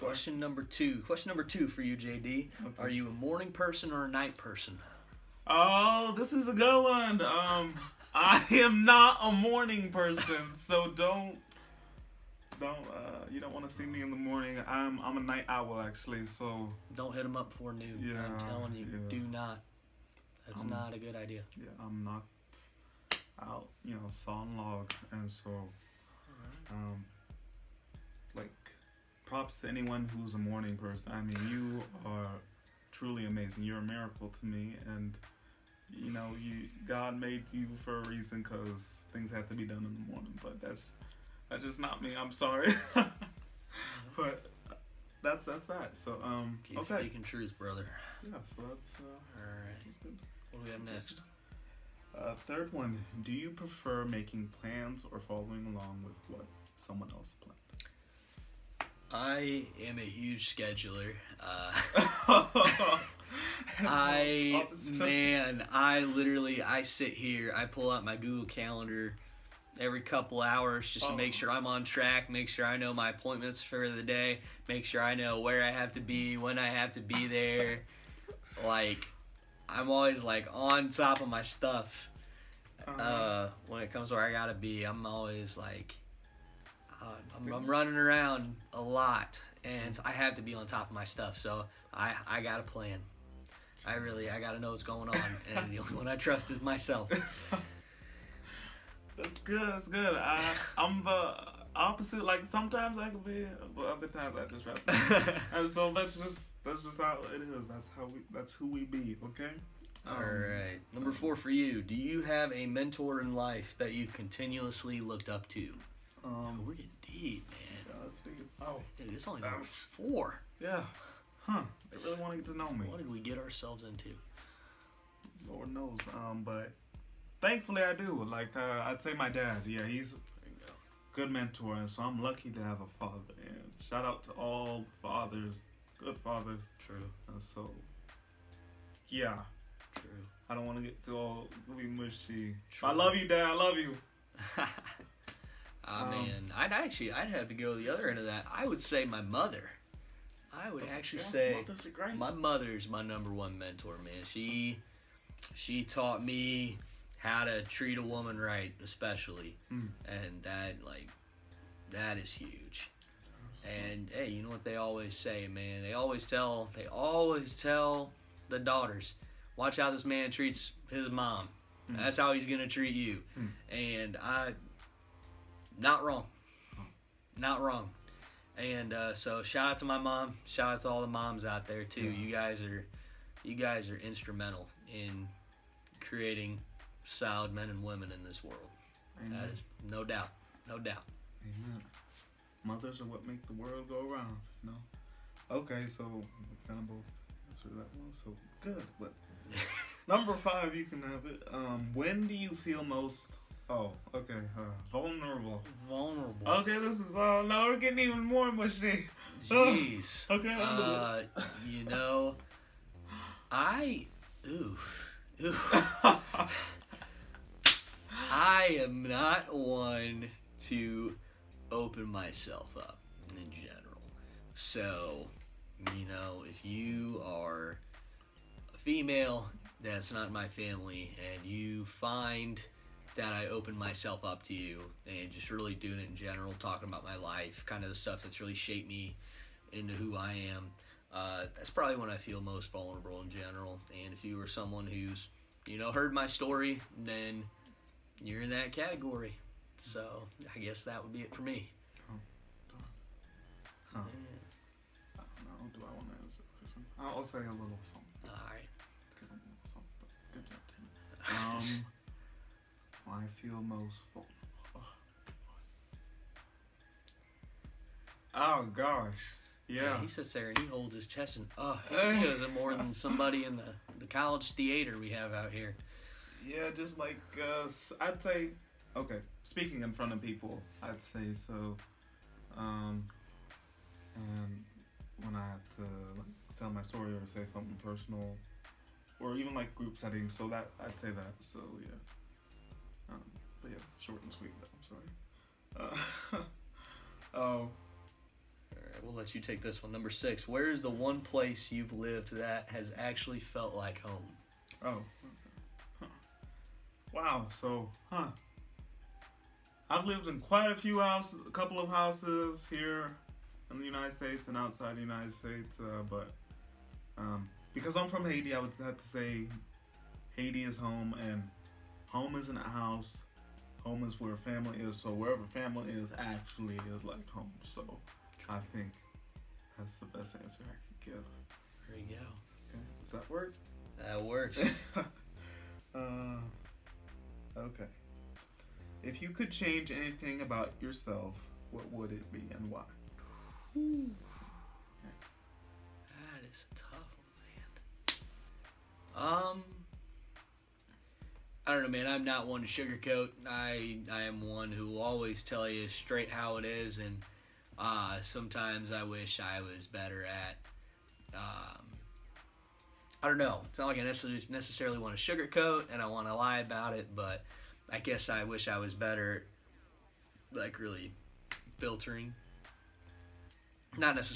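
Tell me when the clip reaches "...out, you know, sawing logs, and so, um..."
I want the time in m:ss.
0:23.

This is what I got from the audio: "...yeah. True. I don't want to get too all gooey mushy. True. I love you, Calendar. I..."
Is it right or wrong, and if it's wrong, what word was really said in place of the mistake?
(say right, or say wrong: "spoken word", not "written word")
wrong: "Dad", not "Calendar".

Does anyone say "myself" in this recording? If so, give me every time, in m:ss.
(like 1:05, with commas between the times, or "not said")
1:36, 3:42, 3:53.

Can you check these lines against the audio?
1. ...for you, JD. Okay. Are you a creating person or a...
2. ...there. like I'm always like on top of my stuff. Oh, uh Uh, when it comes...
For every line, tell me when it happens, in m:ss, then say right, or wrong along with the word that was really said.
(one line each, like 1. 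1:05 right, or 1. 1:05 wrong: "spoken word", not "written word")
1. 0:01 wrong: "morning", not "creating"
2. 1:17 right.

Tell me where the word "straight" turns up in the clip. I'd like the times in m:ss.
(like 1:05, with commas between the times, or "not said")
5:55.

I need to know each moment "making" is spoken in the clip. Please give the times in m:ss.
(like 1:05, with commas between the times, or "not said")
0:54.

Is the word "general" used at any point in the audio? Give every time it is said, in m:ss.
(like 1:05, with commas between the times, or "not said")
3:43, 3:56, 4:03.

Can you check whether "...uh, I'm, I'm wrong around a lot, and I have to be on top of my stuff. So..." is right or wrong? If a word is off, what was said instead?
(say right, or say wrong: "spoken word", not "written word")
wrong: "running", not "wrong".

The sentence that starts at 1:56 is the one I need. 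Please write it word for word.
Um, oh, we're getting deep, man.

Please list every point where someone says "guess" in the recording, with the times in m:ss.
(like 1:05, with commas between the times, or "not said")
4:10, 6:07.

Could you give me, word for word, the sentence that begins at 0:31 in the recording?
I mean, you are truly amazing.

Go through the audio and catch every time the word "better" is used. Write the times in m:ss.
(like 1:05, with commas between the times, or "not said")
5:59, 6:08.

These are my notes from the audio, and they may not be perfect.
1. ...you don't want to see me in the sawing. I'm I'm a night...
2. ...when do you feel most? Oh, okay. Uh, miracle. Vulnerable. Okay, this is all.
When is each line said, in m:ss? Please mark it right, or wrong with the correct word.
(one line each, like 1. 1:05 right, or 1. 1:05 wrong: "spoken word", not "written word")
1. 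0:13 wrong: "morning", not "sawing"
2. 3:21 wrong: "vulnerable", not "miracle".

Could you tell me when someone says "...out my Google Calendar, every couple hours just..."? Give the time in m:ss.
1:07.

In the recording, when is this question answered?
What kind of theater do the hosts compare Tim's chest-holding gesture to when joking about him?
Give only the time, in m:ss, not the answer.
4:34.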